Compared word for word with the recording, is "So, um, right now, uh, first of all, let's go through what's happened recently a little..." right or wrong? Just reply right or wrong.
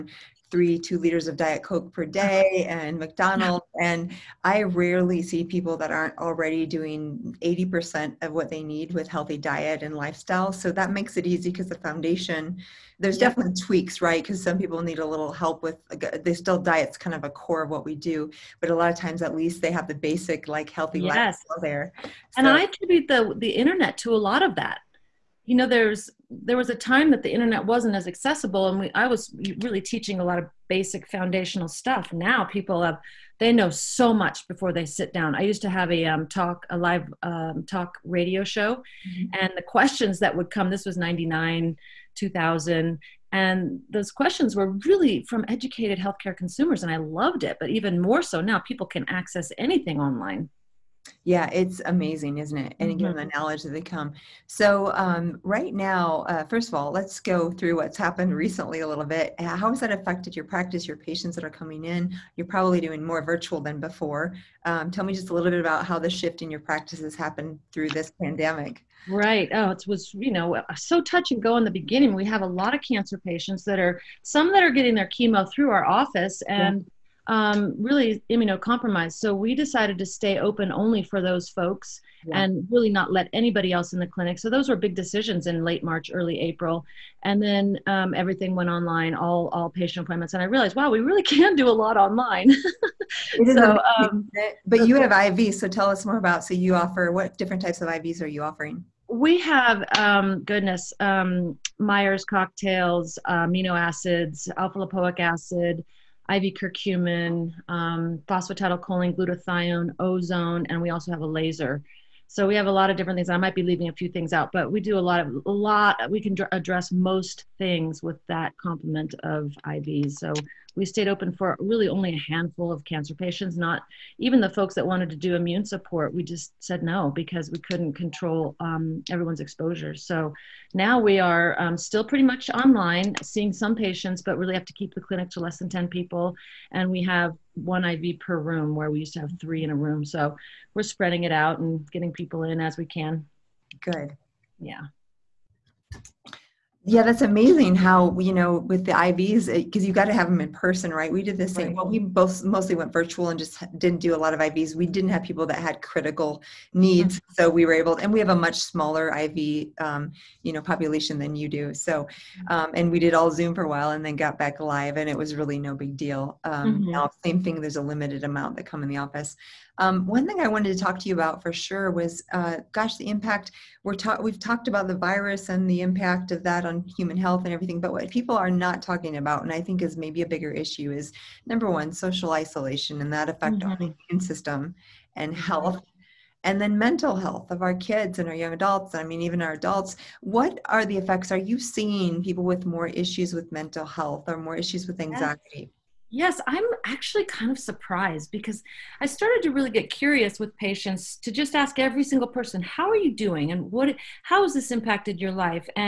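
right.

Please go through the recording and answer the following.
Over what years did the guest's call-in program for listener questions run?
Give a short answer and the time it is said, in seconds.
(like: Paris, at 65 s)
1999-2000, at 40 s.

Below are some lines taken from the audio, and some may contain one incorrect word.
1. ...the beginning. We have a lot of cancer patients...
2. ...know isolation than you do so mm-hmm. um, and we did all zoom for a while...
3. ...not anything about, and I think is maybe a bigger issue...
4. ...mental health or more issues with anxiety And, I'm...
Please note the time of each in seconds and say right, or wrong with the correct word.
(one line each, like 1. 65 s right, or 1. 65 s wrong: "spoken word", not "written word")
1. 71 s right
2. 160 s wrong: "population", not "isolation"
3. 178 s wrong: "talking", not "anything"
4. 193 s wrong: "Yes", not "And".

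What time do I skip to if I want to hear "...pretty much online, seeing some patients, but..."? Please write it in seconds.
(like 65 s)
132 s.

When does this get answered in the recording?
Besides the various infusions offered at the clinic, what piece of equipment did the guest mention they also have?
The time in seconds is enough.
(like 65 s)
111 s.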